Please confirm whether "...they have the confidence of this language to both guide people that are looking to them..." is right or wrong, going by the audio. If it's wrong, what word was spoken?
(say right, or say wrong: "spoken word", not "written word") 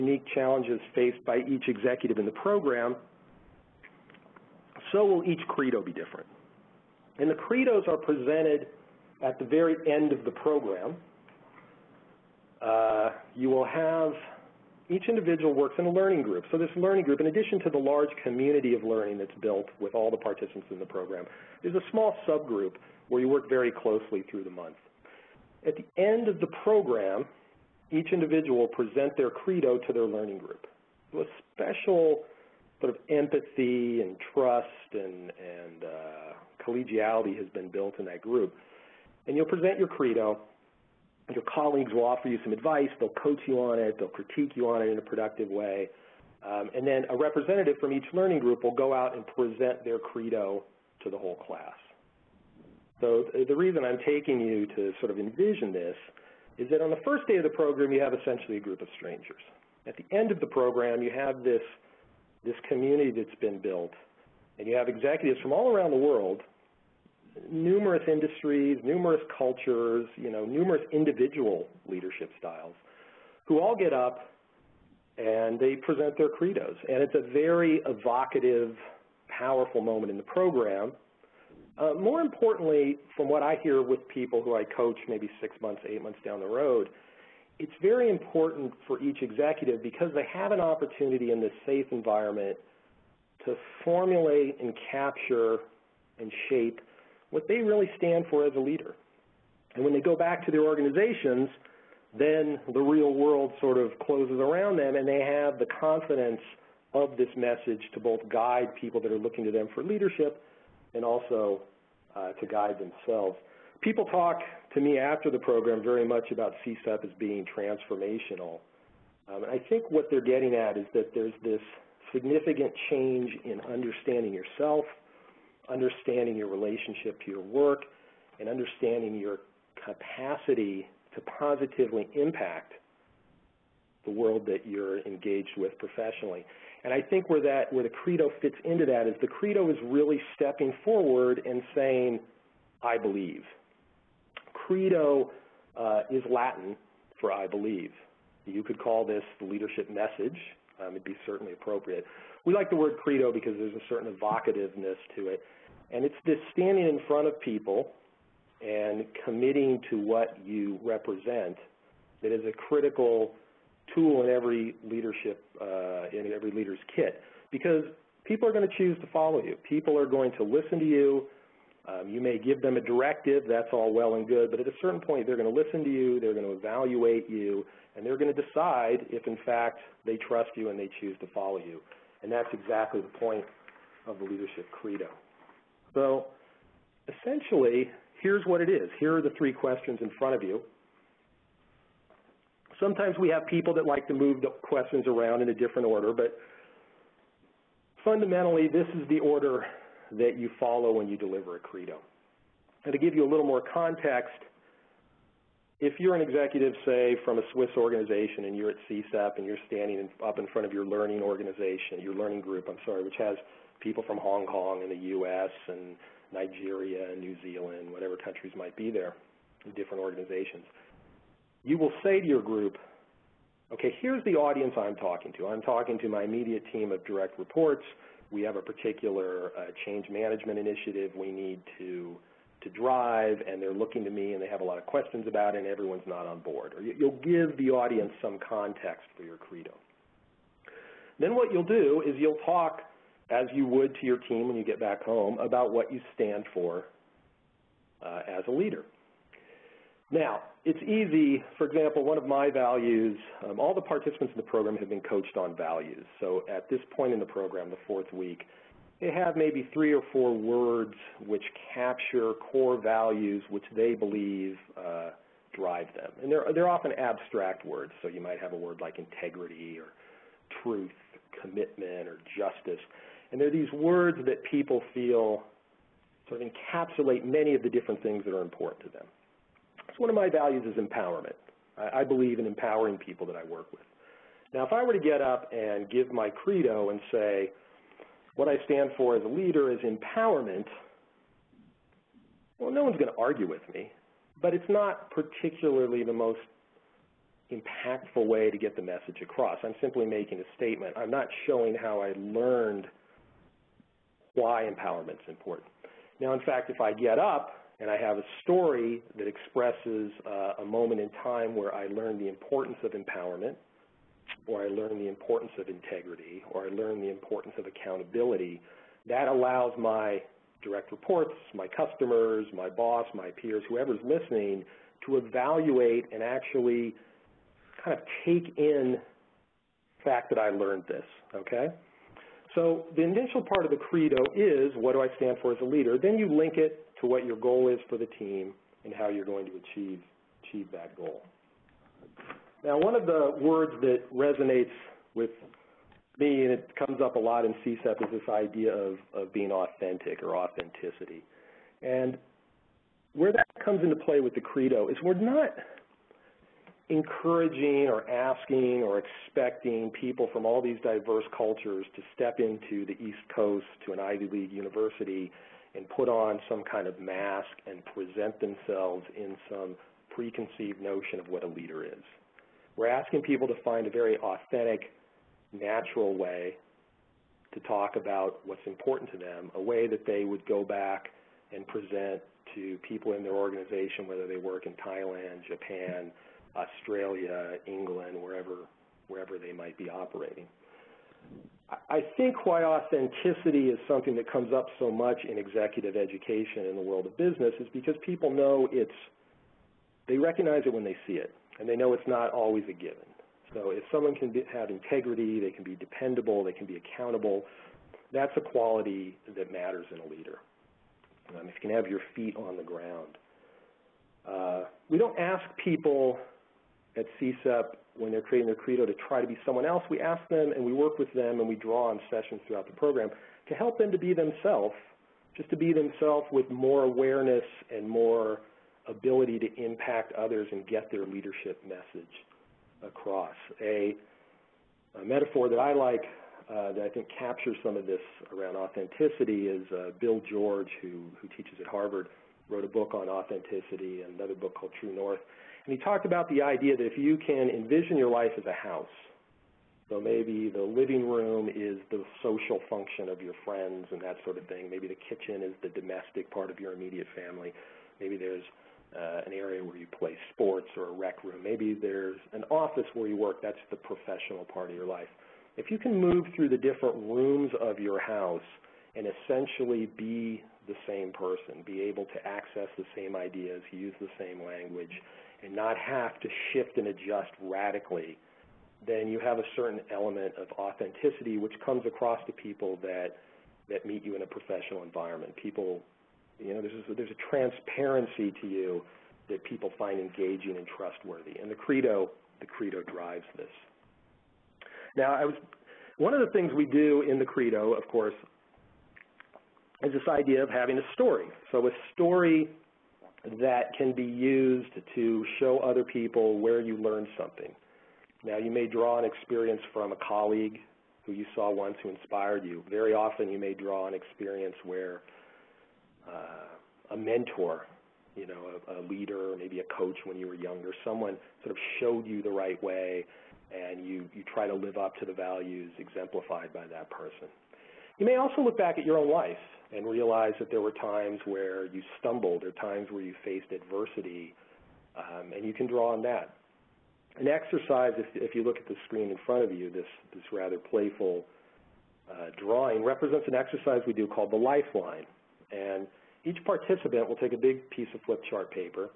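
wrong: "message", not "language".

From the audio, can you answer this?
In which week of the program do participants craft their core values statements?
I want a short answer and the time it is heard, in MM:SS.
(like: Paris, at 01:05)
Fourth week, at 04:17.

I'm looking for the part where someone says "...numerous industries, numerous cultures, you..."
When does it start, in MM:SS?
01:07.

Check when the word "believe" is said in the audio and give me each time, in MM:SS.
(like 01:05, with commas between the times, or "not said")
02:22, 02:27, 04:23, 04:42.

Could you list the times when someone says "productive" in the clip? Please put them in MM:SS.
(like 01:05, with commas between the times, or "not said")
00:45.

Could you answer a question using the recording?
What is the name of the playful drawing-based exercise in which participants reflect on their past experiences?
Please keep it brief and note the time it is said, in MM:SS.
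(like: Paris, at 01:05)
The lifeline, at 09:04.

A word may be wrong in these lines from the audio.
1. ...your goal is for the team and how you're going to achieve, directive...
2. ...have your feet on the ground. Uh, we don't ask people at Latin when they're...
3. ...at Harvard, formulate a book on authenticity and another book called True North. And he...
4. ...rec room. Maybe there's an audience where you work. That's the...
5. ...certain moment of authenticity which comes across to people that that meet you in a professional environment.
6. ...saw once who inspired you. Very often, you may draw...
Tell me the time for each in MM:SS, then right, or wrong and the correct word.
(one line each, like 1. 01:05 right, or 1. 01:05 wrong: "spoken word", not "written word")
1. 05:37 wrong: "achieve", not "directive"
2. 06:51 wrong: "CSEP", not "Latin"
3. 07:21 wrong: "wrote", not "formulate"
4. 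07:40 wrong: "office", not "audience"
5. 07:59 wrong: "element", not "moment"
6. 08:31 right.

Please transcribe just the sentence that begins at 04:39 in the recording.
So one of my values is empowerment.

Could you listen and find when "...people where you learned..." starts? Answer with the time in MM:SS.
08:25.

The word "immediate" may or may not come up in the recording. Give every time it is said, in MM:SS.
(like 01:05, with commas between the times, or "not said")
03:46, 07:36.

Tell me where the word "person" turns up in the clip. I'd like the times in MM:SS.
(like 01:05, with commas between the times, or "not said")
07:51, 08:46.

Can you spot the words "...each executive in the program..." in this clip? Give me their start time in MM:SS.
00:01.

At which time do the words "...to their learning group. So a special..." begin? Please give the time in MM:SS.
00:29.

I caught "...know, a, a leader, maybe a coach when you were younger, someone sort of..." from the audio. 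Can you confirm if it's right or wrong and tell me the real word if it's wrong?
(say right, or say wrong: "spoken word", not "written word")
right.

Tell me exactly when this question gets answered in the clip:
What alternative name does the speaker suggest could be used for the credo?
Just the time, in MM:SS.
02:29.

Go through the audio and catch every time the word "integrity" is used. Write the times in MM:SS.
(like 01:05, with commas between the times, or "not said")
04:28, 05:15, 06:44.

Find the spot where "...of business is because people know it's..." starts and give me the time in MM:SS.
06:37.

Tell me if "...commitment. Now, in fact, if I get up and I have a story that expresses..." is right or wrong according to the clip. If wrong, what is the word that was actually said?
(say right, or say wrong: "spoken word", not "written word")
wrong: "important", not "commitment".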